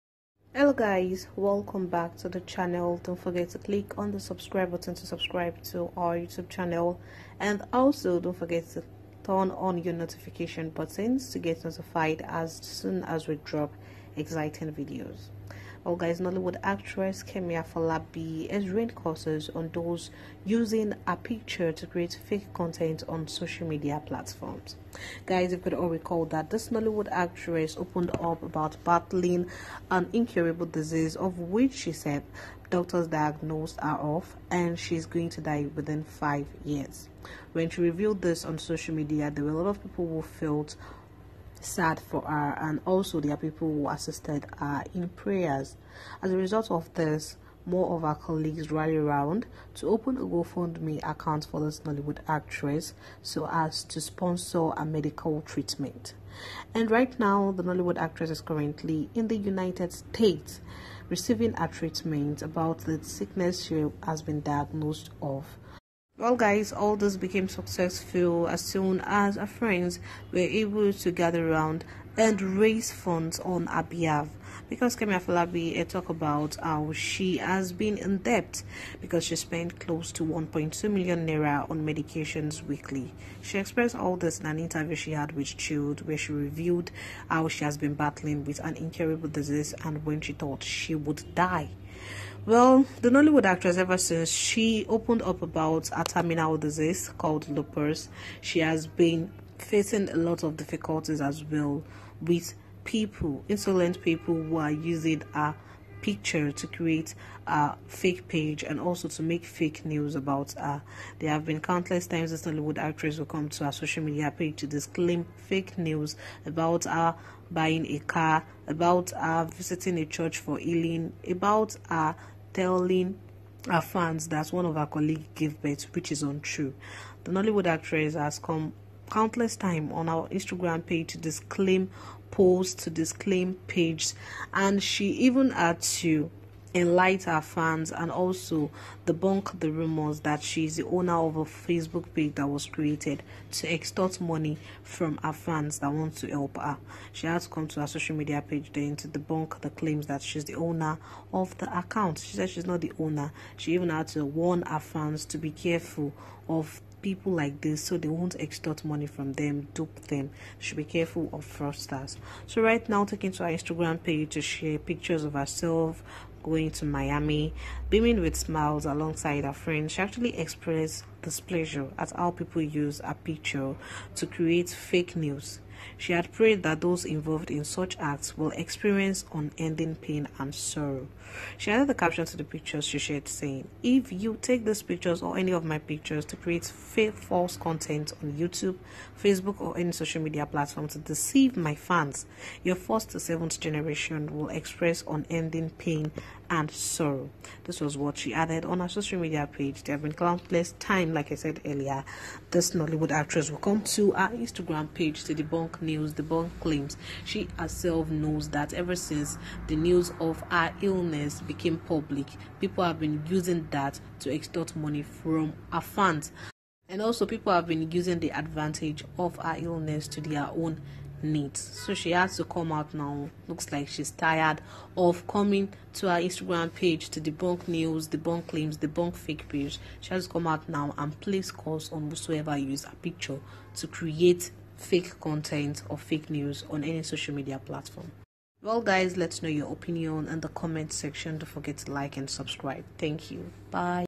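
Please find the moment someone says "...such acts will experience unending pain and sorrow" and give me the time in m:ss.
2:57.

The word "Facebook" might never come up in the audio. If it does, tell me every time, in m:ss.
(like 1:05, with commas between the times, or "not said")
2:21, 3:09.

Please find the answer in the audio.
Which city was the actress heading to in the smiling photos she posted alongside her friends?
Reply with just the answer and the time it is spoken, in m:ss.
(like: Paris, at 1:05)
Miami, at 2:46.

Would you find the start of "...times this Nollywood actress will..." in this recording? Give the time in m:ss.
1:52.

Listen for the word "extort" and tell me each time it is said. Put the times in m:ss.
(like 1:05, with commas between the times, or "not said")
2:23, 2:38, 3:34.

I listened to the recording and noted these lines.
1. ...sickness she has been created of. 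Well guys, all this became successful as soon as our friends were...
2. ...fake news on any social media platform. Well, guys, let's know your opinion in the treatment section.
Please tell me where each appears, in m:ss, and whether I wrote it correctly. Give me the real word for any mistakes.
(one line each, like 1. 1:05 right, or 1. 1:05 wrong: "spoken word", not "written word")
1. 1:03 wrong: "diagnosed", not "created"
2. 3:55 wrong: "comment", not "treatment".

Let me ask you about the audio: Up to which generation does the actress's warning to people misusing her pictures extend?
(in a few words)
Seventh.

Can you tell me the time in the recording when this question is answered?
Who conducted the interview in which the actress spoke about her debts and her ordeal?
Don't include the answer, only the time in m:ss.
1:25.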